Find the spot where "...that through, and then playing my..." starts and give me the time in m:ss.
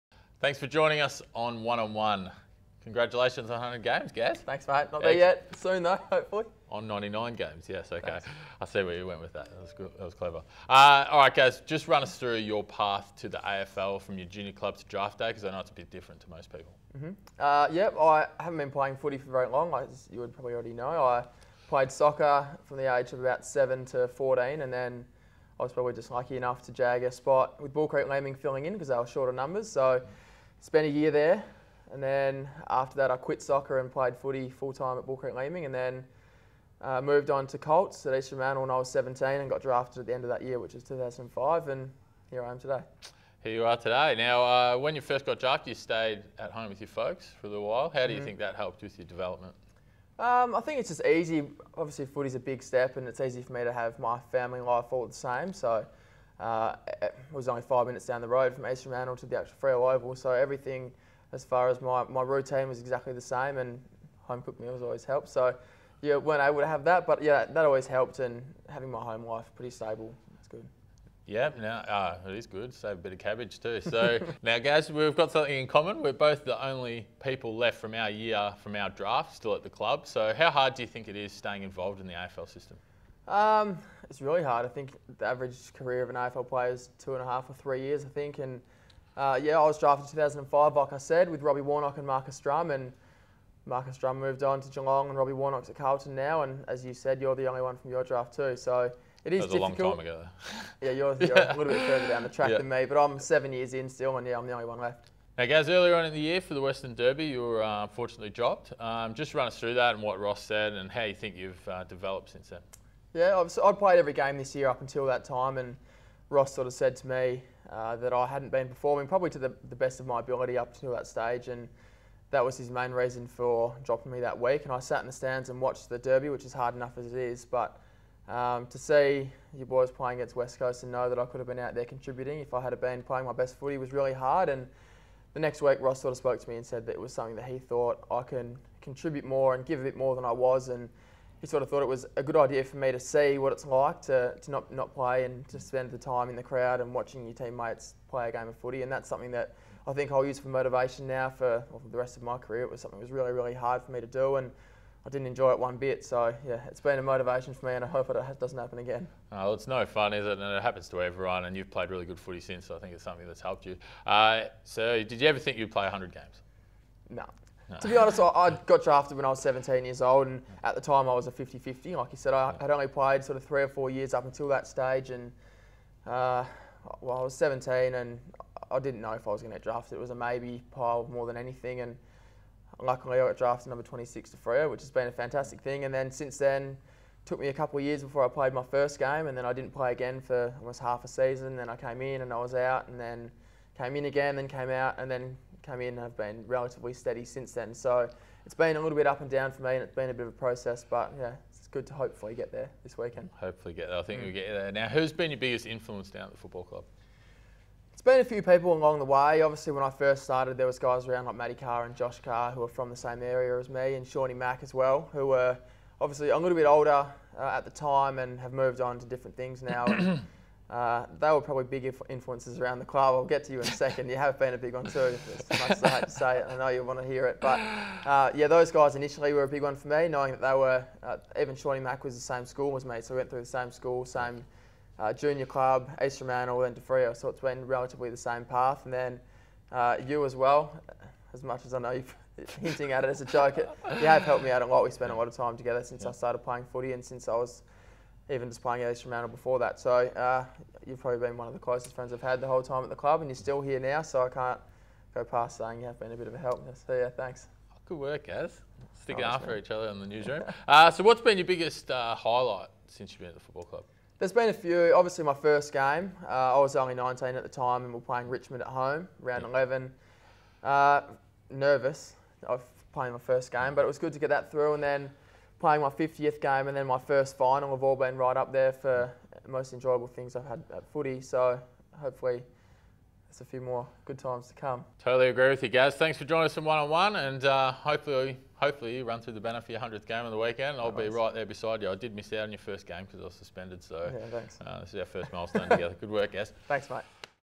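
4:34.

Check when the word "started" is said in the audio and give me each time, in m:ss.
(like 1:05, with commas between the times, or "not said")
3:30, 4:06.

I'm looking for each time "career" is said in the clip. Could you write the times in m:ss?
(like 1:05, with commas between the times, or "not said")
1:25, 2:32.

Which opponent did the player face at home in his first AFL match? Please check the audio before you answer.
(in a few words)
Richmond.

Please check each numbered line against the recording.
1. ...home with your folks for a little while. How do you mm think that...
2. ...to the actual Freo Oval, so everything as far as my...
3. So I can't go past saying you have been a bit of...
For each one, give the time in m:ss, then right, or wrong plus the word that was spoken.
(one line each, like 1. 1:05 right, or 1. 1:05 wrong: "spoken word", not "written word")
1. 0:46 right
2. 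0:59 right
3. 4:14 right.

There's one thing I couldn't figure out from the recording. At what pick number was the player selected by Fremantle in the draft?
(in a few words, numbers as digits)
26.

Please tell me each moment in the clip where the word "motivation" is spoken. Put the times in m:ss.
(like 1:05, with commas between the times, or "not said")
2:30, 2:37.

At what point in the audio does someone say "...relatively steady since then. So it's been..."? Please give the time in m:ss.
3:16.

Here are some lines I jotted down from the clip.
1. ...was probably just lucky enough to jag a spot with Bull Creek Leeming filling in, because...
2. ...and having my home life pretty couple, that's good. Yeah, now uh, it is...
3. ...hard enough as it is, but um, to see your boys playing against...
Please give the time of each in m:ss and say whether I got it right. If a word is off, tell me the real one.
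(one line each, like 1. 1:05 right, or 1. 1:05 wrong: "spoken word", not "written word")
1. 0:25 right
2. 1:08 wrong: "stable", not "couple"
3. 2:06 right.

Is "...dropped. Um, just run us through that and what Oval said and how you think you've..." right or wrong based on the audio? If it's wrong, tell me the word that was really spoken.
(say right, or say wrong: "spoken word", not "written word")
wrong: "Ross", not "Oval".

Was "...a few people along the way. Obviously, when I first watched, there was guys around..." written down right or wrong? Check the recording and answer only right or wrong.
wrong.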